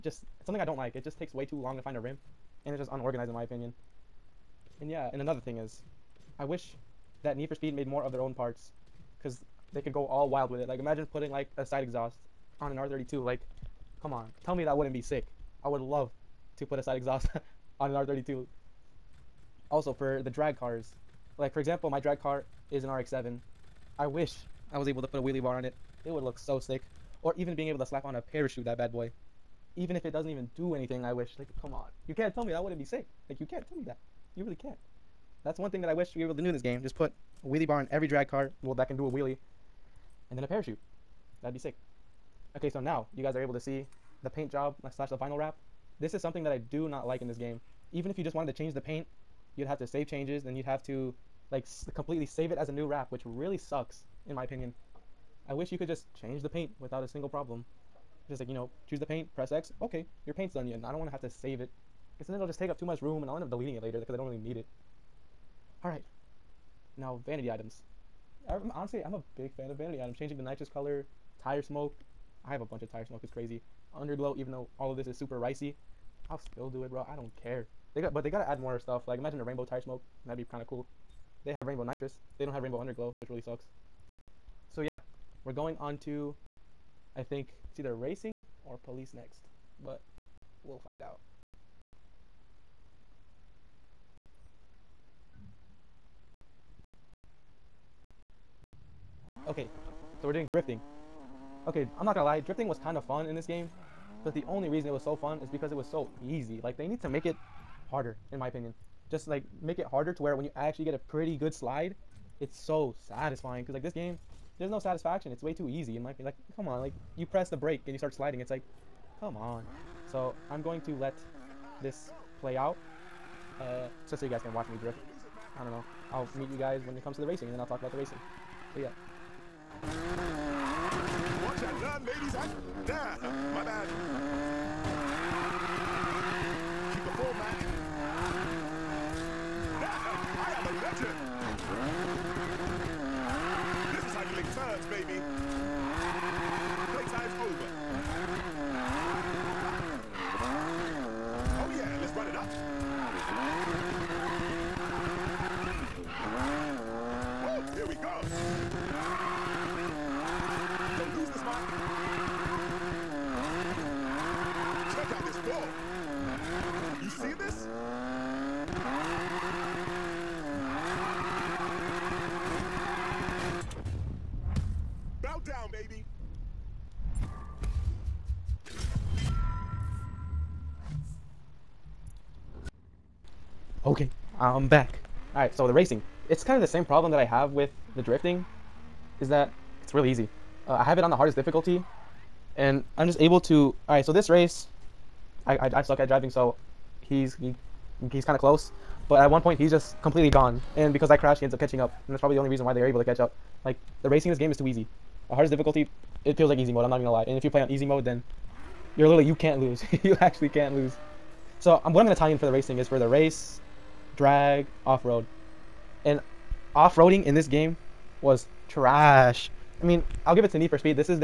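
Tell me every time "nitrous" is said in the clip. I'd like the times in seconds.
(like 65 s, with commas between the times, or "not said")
70 s, 81 s.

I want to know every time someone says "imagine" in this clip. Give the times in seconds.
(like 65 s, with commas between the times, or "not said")
10 s, 79 s.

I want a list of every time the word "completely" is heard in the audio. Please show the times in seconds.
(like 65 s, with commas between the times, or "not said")
51 s, 200 s.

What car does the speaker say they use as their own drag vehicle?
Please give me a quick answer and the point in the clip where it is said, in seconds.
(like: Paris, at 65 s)
RX-7, at 22 s.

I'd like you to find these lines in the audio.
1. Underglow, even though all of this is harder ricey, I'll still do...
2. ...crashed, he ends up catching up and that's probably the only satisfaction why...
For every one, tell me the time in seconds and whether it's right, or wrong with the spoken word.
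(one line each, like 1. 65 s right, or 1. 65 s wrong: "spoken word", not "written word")
1. 73 s wrong: "super", not "harder"
2. 201 s wrong: "reason", not "satisfaction".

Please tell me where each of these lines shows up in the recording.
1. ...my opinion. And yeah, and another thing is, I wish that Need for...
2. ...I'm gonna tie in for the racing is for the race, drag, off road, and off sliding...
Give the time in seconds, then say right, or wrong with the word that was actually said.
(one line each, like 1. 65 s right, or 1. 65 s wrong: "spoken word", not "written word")
1. 3 s right
2. 212 s wrong: "roading", not "sliding".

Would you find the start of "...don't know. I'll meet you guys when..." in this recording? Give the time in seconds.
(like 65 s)
125 s.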